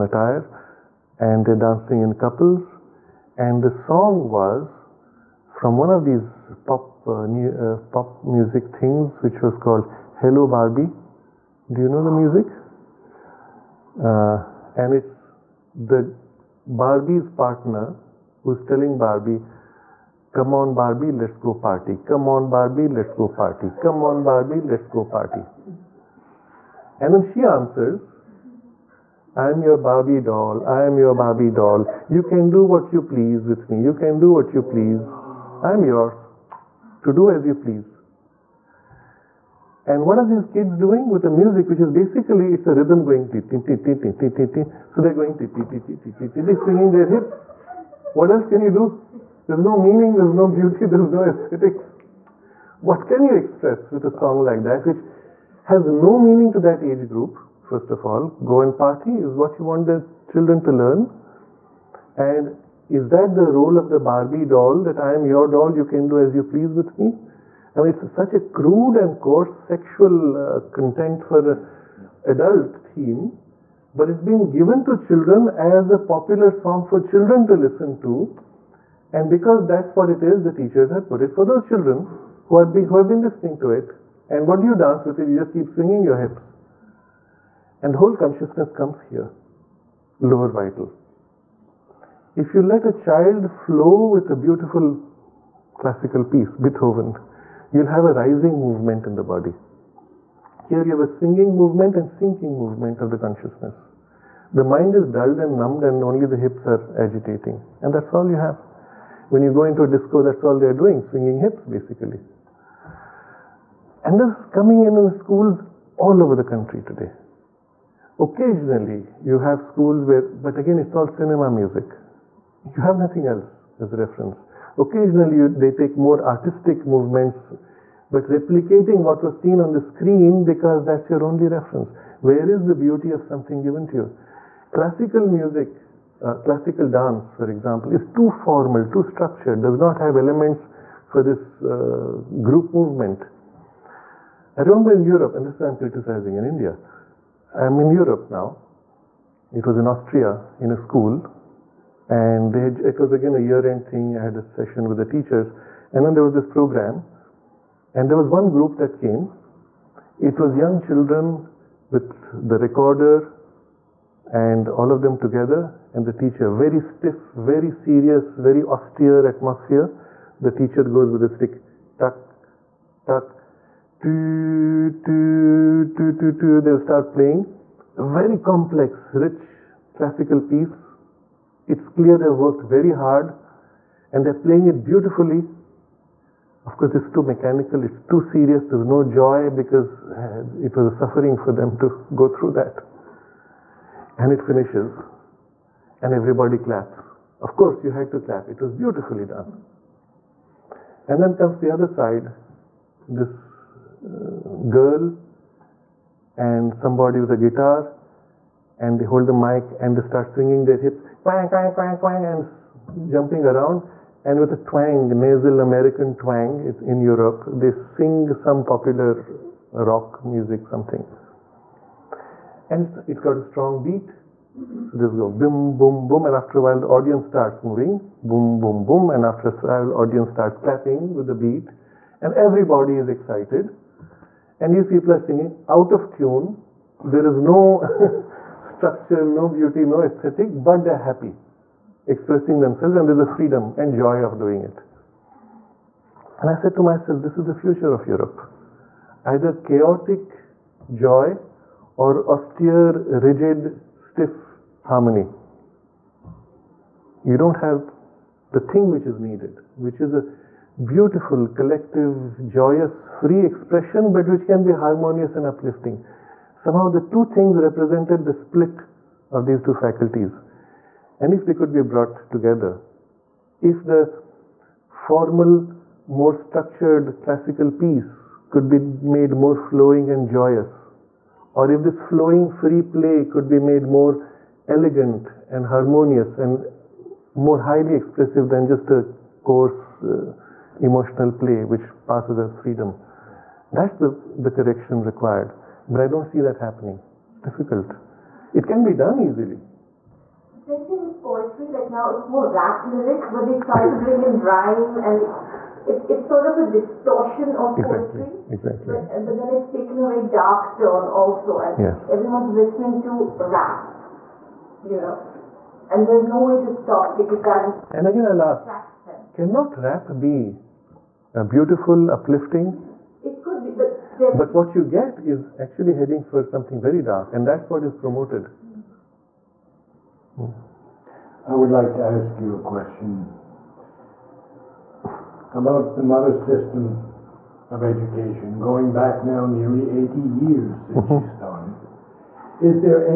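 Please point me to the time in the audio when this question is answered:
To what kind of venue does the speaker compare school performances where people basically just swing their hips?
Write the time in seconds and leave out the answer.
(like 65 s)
109 s.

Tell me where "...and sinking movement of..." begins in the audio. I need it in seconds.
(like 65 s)
101 s.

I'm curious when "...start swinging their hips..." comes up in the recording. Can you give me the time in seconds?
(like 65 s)
209 s.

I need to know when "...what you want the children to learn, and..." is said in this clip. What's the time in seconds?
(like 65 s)
59 s.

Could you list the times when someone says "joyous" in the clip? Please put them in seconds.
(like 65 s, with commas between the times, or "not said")
262 s, 280 s.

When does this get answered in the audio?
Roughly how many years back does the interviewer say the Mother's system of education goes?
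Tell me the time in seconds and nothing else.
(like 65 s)
339 s.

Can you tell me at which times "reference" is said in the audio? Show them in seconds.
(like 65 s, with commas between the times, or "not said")
123 s, 131 s.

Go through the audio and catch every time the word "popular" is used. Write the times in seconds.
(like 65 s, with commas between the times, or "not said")
75 s, 218 s.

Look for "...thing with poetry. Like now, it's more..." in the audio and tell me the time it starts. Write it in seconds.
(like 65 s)
300 s.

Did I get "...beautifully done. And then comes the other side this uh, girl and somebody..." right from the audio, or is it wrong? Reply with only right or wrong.
right.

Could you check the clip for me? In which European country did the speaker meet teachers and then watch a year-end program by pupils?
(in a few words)
Austria.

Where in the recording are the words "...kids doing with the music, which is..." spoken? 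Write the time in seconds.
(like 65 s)
40 s.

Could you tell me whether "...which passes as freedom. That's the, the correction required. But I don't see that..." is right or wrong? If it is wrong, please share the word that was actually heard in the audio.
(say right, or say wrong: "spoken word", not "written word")
right.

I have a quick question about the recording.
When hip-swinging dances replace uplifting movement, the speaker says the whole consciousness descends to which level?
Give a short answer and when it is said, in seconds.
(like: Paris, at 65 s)
lower vital, at 90 s.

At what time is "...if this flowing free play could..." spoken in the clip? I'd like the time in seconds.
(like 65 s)
281 s.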